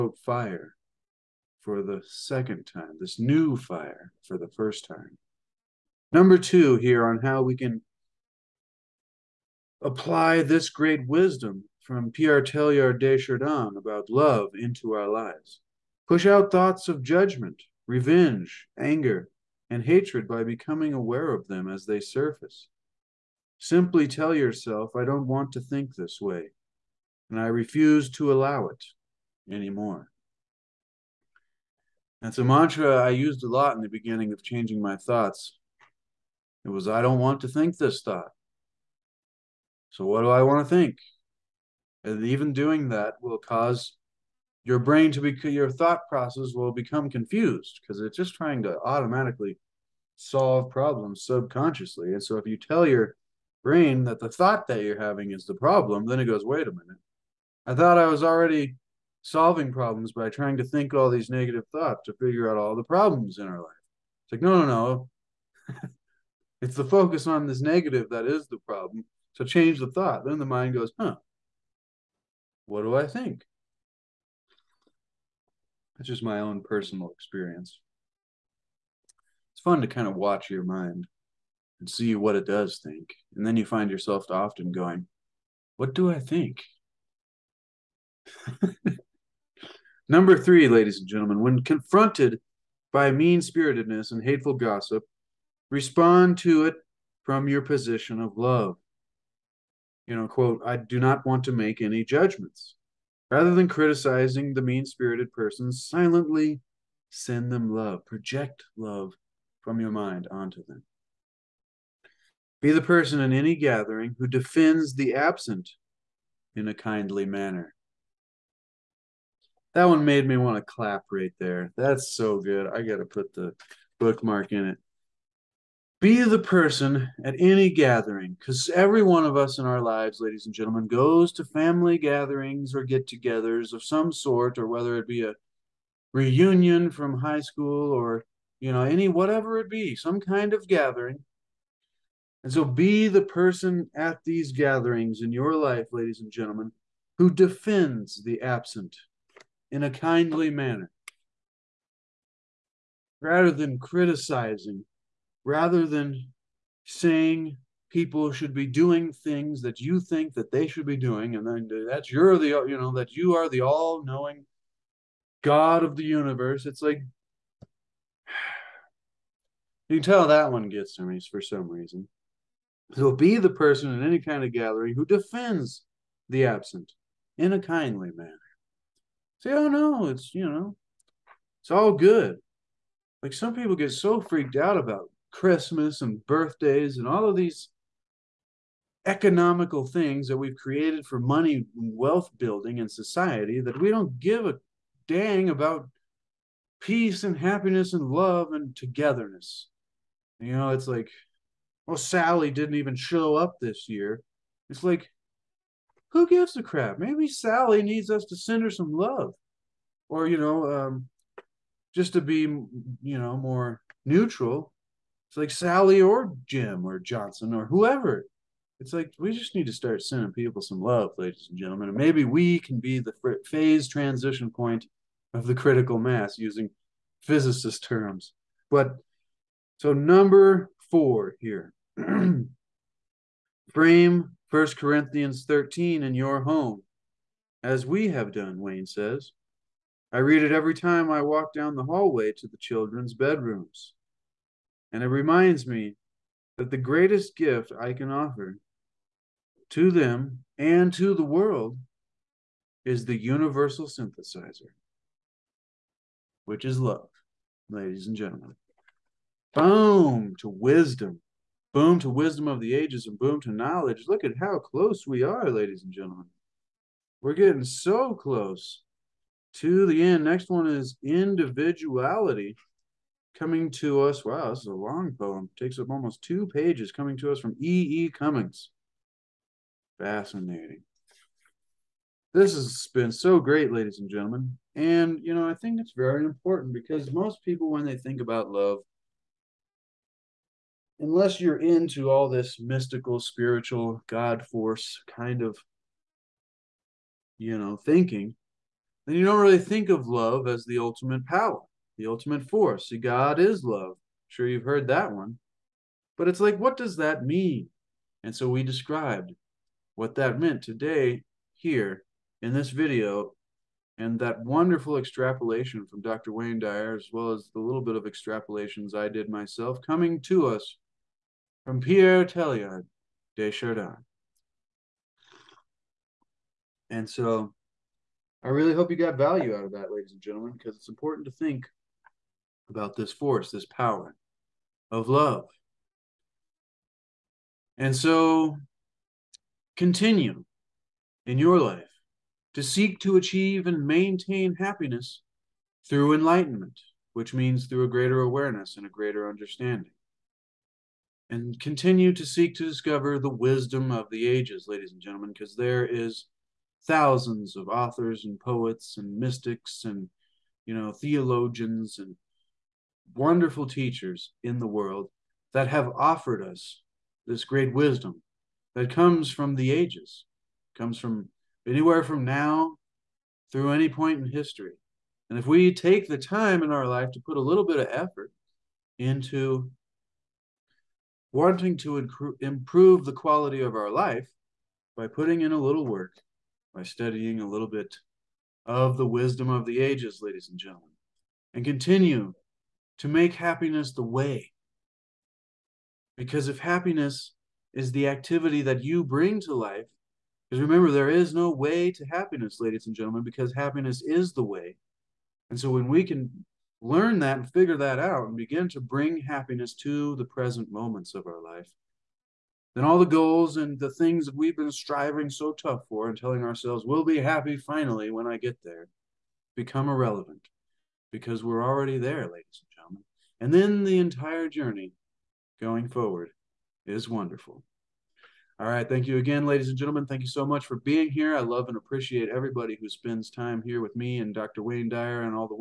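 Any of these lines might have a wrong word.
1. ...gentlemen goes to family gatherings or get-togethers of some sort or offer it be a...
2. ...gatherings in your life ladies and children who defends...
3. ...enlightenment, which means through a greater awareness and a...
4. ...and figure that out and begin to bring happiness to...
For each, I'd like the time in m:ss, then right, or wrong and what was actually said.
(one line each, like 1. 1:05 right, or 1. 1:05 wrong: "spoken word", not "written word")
1. 2:10 wrong: "whether", not "offer"
2. 2:24 wrong: "gentlemen", not "children"
3. 5:46 right
4. 6:47 right.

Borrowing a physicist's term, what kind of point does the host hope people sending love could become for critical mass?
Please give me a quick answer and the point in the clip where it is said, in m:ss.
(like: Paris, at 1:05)
Phase transition point, at 3:43.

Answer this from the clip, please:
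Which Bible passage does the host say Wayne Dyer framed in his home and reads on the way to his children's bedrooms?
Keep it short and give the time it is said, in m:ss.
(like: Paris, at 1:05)
First Corinthians 13, at 3:54.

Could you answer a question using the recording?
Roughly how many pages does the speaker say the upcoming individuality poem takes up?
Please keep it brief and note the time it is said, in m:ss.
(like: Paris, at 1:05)
2, at 4:36.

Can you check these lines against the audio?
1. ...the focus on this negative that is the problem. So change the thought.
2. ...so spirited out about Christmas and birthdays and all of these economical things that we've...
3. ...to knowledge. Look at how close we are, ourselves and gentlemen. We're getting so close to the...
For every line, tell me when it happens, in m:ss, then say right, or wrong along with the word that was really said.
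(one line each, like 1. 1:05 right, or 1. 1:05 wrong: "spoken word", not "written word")
1. 1:06 right
2. 3:03 wrong: "freaked", not "spirited"
3. 4:23 wrong: "ladies", not "ourselves".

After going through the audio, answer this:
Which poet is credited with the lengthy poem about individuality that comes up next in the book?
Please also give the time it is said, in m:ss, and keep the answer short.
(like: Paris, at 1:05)
E. E. Cummings, at 4:37.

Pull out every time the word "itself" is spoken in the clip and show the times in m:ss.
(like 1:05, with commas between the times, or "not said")
not said.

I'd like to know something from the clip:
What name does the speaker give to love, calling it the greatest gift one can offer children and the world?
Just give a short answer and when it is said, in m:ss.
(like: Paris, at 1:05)
The universal synthesizer, at 4:13.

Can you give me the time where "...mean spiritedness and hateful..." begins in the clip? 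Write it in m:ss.
1:33.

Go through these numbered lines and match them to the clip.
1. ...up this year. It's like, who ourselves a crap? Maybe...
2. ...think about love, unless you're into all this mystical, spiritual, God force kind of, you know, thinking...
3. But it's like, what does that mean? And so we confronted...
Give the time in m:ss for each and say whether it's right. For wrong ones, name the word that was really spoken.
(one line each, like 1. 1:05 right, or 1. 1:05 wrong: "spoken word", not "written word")
1. 3:23 wrong: "gives", not "ourselves"
2. 4:47 right
3. 5:06 wrong: "described", not "confronted".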